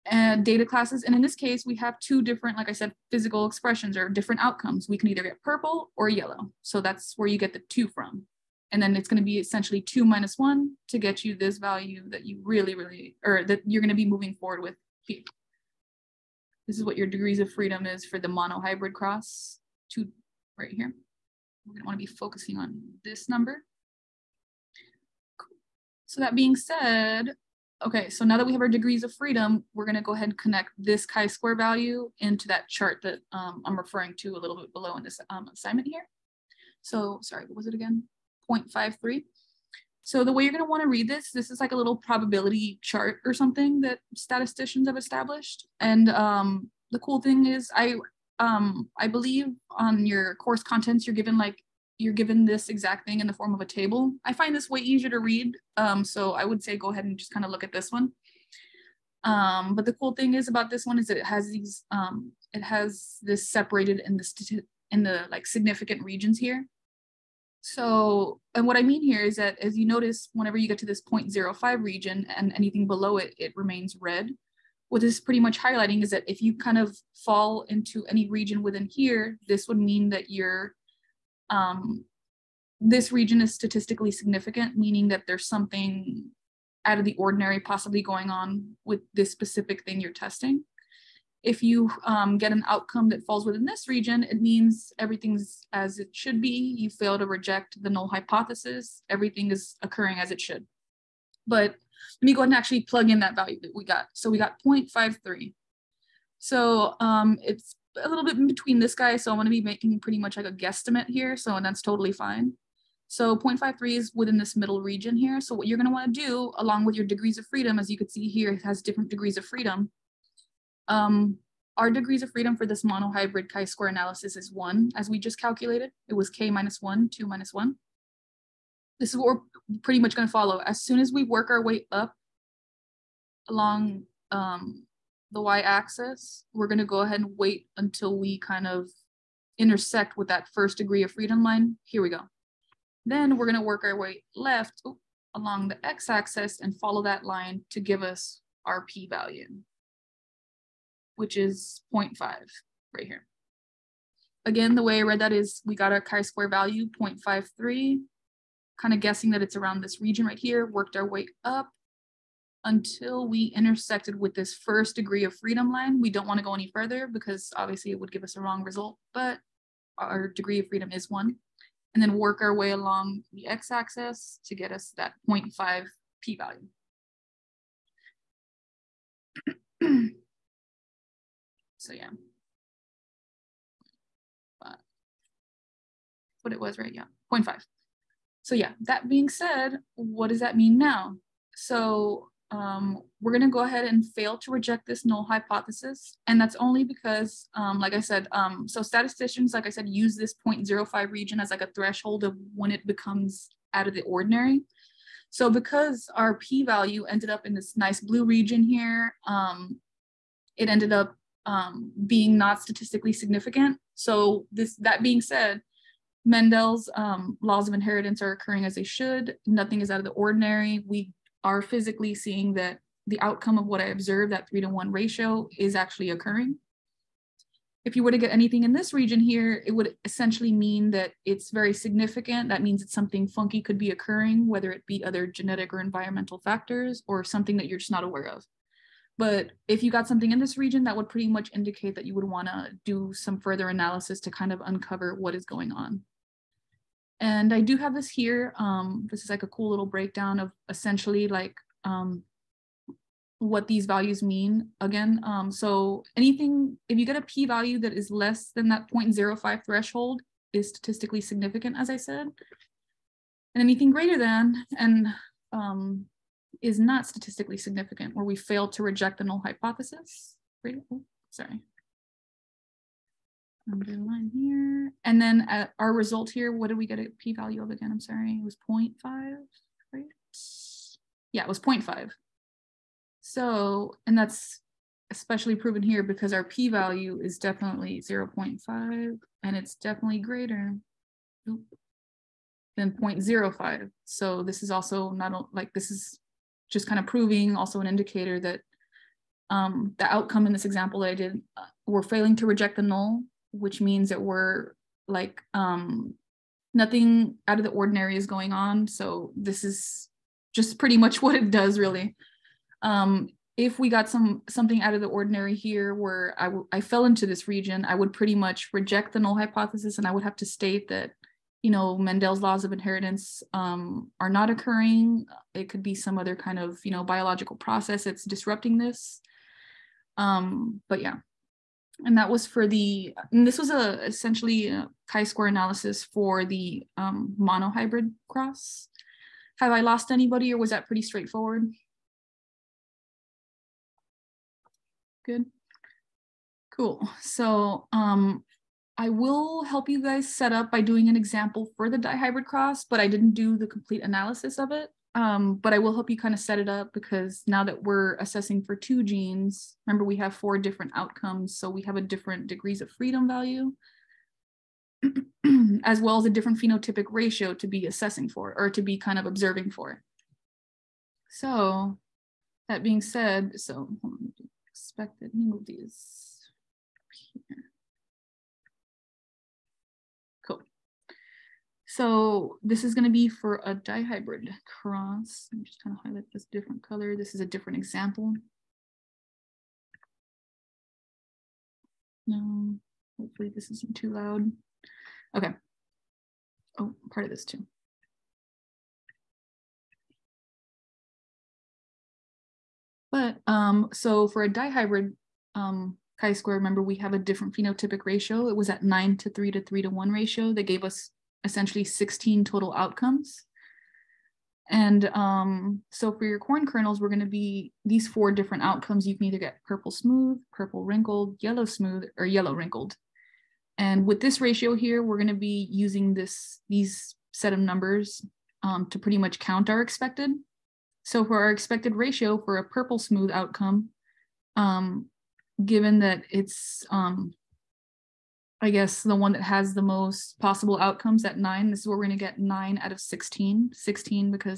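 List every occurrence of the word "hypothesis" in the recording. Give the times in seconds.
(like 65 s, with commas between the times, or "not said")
98 s, 195 s, 269 s, 319 s.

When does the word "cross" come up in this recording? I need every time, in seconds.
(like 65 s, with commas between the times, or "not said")
18 s, 338 s, 352 s, 384 s.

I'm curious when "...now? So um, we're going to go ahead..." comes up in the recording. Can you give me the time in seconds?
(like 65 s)
190 s.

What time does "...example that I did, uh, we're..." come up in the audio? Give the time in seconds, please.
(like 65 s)
300 s.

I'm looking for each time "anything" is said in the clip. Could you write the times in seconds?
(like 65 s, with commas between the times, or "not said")
72 s, 228 s, 256 s, 263 s.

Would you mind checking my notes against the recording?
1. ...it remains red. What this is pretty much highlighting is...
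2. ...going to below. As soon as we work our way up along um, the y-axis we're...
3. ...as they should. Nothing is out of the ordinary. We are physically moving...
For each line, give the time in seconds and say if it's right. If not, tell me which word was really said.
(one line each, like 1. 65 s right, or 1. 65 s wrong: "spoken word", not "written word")
1. 73 s right
2. 130 s wrong: "follow", not "below"
3. 218 s wrong: "seeing", not "moving".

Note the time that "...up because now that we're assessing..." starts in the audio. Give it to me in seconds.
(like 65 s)
356 s.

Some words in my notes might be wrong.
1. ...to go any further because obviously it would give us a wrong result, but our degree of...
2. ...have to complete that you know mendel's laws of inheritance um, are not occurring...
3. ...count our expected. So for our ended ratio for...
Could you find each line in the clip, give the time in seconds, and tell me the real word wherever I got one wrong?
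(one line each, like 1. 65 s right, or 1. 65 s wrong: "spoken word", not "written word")
1. 166 s right
2. 320 s wrong: "state", not "complete"
3. 429 s wrong: "expected", not "ended".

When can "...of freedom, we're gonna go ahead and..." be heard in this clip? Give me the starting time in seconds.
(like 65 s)
29 s.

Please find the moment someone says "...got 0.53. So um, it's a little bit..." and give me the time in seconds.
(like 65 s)
104 s.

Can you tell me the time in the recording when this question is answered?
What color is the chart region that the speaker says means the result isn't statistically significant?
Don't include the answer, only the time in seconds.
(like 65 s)
207 s.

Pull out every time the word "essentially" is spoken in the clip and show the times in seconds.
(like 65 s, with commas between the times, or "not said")
9 s, 230 s, 250 s, 334 s, 411 s.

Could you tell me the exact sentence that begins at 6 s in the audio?
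So that's where you get the two from.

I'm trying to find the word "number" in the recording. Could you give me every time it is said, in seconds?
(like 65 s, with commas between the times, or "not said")
23 s, 427 s.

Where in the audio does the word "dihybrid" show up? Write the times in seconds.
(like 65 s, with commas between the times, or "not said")
351 s, 383 s, 404 s.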